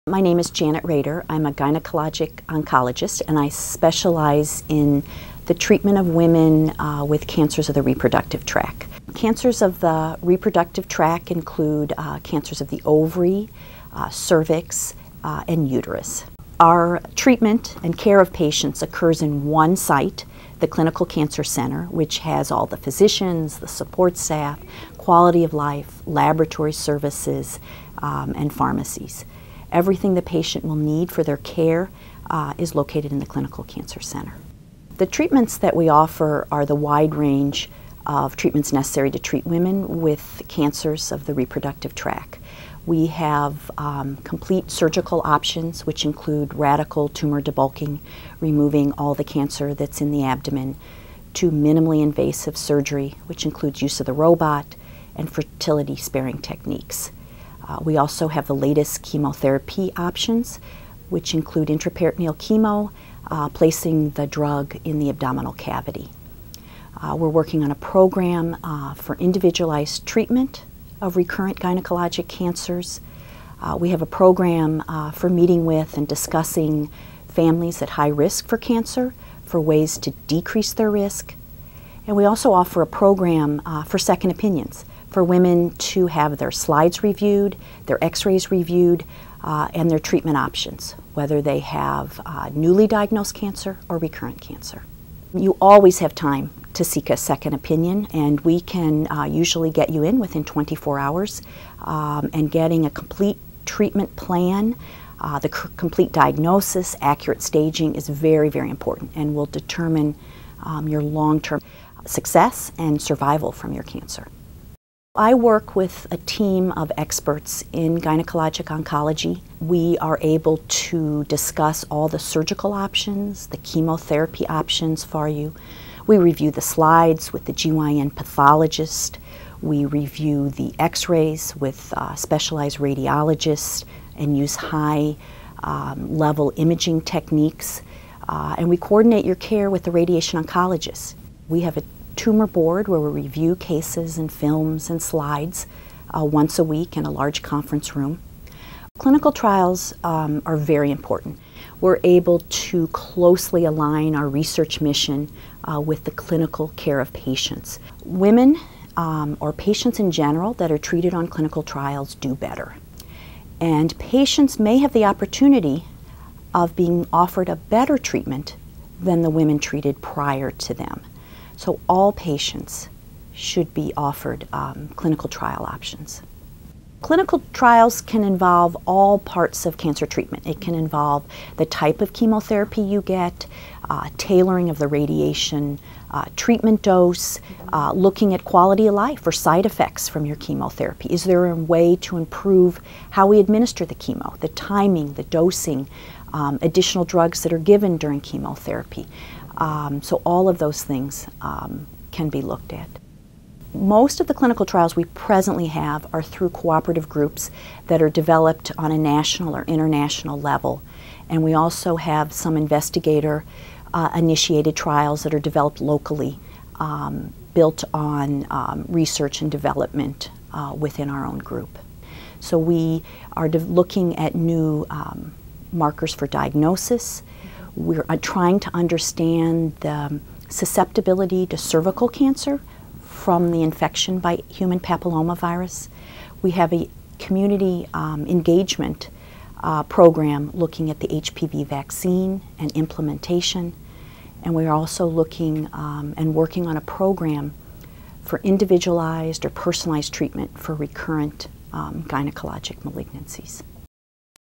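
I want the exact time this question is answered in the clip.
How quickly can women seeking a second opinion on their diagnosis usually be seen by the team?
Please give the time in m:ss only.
1:40.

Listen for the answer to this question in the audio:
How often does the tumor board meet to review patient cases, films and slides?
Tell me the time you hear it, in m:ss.
2:26.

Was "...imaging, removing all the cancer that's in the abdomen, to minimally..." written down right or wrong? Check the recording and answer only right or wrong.
wrong.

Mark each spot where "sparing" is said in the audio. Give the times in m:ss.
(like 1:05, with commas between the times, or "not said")
0:55.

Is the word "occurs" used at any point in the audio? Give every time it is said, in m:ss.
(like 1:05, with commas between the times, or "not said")
0:18.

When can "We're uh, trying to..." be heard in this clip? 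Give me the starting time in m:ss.
3:47.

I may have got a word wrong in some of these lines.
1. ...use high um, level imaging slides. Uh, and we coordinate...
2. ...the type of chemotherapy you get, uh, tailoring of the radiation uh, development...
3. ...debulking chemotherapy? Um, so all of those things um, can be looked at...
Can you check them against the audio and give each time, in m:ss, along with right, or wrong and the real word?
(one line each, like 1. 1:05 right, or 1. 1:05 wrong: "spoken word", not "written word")
1. 2:14 wrong: "techniques", not "slides"
2. 3:01 wrong: "treatment", not "development"
3. 3:17 wrong: "during", not "debulking".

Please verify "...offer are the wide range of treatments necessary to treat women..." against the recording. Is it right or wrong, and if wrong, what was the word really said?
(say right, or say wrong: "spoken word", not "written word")
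right.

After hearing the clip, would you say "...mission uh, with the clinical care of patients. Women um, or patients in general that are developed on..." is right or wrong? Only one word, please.
wrong.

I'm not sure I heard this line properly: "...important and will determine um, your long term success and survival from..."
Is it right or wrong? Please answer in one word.
right.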